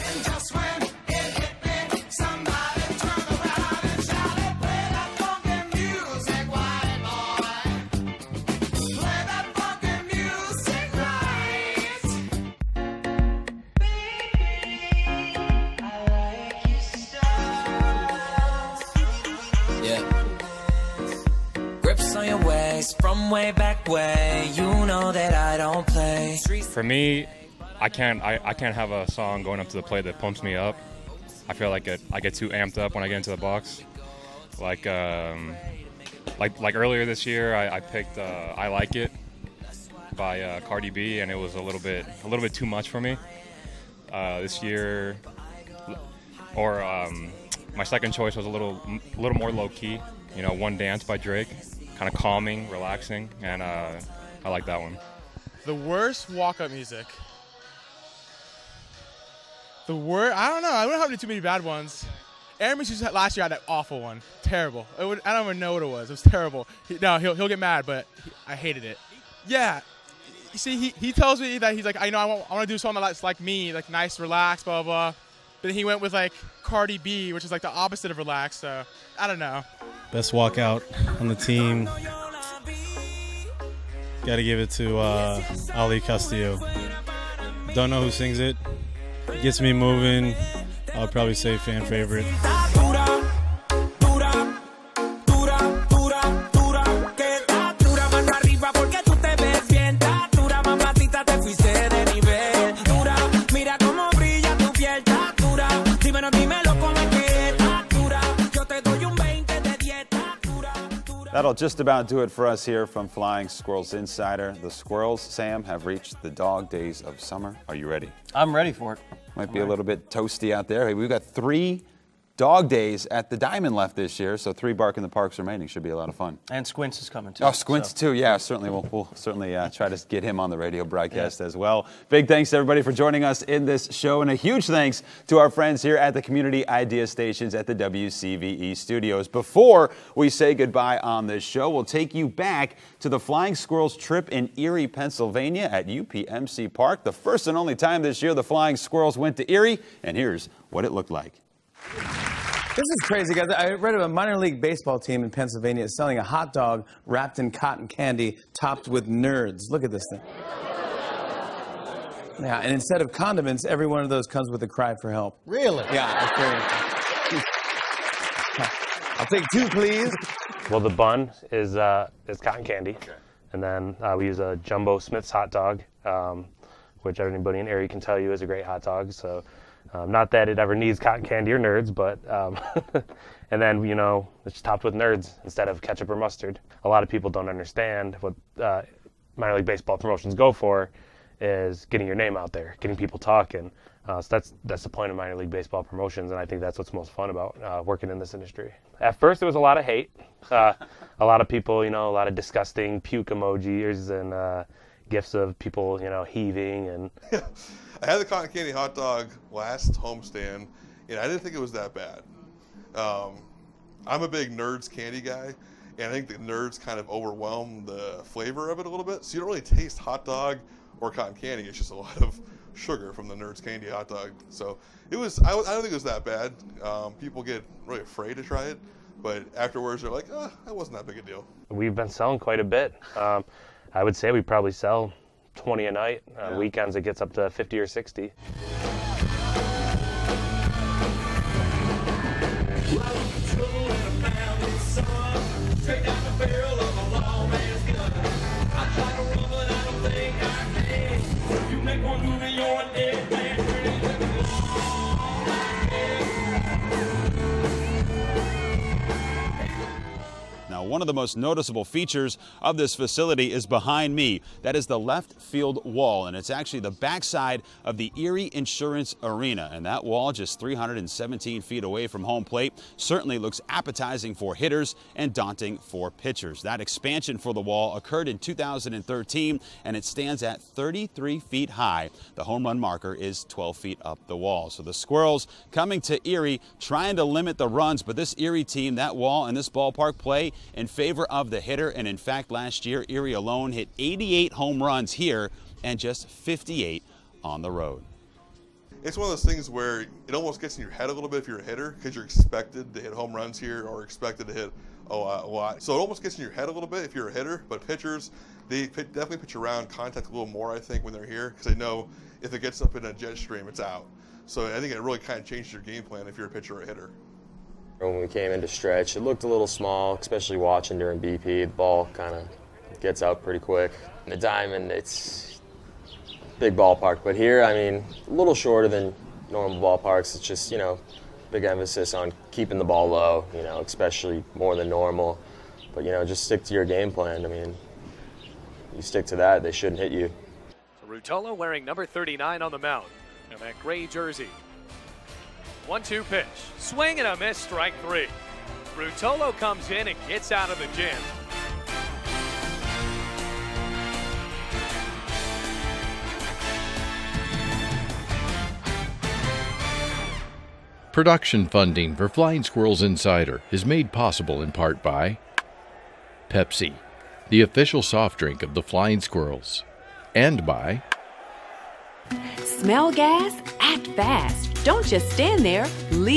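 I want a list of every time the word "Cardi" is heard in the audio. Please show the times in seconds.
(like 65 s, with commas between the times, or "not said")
40 s, 76 s.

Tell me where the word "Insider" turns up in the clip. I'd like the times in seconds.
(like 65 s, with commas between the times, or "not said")
113 s, 363 s.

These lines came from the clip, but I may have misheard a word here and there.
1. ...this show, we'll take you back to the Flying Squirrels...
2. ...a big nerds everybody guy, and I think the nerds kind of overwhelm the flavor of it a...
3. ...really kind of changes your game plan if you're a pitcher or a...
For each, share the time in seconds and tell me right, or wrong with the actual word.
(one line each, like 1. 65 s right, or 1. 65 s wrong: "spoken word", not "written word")
1. 141 s right
2. 214 s wrong: "candy", not "everybody"
3. 315 s right.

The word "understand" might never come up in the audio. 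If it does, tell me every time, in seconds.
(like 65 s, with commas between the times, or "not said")
187 s.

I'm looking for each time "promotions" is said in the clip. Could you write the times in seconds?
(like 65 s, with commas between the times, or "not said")
189 s, 195 s.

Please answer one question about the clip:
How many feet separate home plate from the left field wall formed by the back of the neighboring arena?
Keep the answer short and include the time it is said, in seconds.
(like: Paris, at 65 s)
317, at 270 s.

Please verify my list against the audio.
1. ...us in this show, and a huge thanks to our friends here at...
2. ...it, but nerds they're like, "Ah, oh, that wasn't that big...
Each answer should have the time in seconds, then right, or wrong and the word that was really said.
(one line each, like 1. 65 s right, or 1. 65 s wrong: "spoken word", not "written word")
1. 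133 s right
2. 228 s wrong: "afterwards", not "nerds".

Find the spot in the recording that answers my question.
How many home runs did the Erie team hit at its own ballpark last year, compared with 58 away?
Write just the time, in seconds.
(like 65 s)
293 s.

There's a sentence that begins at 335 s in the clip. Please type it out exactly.
But you know, just stick to your game plan.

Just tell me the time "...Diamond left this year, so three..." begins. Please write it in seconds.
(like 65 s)
123 s.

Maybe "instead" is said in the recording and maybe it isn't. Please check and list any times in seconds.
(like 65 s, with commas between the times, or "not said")
162 s, 185 s.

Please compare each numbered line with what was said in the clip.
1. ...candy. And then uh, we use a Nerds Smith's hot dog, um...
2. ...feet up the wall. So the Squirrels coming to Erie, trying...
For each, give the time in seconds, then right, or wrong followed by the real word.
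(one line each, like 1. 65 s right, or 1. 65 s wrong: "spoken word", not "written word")
1. 172 s wrong: "Jumbo", not "Nerds"
2. 283 s right.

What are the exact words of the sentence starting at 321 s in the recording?
The ball kind of gets out pretty quick.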